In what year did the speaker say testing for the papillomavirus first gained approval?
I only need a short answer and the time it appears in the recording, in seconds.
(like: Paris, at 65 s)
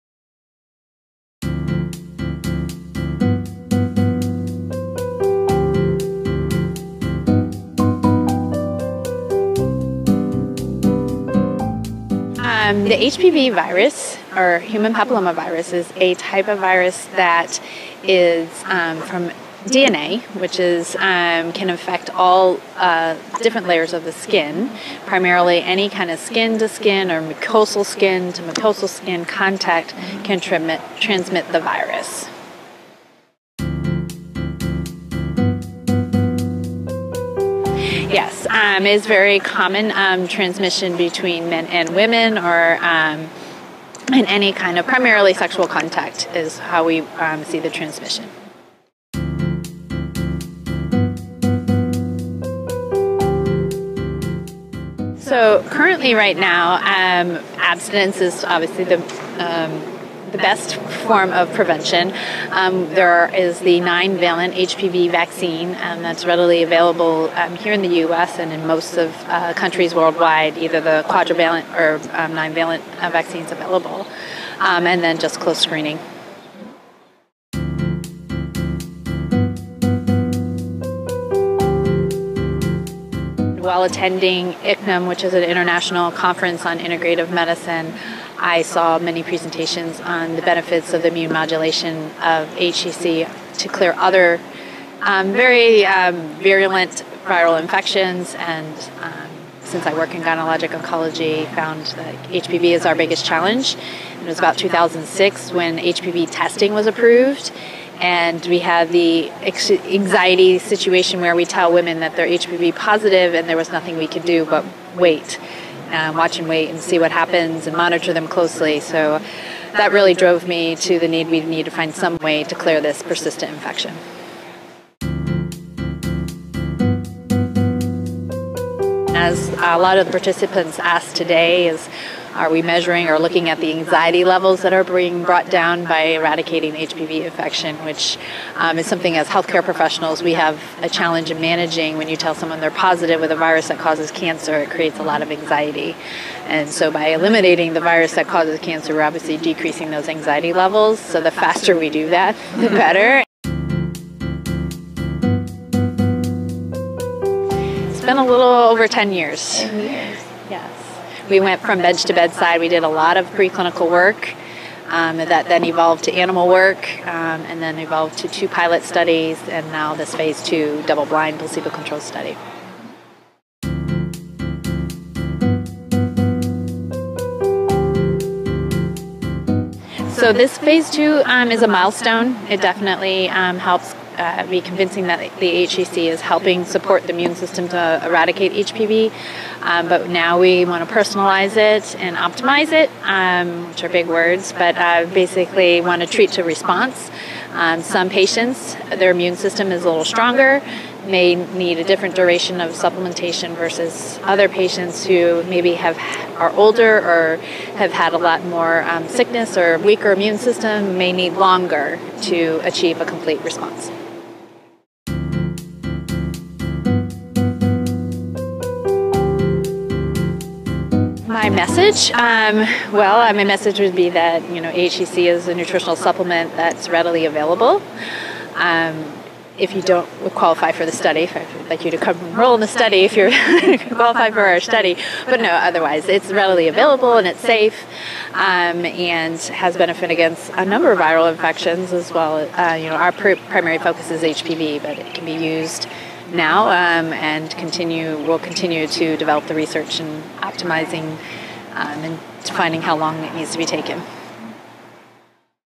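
2006, at 104 s.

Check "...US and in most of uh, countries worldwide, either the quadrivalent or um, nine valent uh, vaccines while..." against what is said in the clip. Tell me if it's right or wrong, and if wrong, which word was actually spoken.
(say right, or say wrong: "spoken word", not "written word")
wrong: "available", not "while".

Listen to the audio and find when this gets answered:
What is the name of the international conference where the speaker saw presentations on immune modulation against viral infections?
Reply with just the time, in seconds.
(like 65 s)
84 s.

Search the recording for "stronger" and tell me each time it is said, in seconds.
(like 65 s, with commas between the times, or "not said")
200 s.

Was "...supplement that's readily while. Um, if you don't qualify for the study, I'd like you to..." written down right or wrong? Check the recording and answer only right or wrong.
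wrong.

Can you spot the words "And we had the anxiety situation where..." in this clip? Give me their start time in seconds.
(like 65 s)
107 s.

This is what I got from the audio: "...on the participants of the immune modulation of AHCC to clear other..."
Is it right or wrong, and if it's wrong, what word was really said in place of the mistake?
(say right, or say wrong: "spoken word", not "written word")
wrong: "benefits", not "participants".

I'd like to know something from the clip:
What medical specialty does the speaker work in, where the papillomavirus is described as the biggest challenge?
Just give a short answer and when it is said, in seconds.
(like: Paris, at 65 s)
Gynecologic oncology, at 100 s.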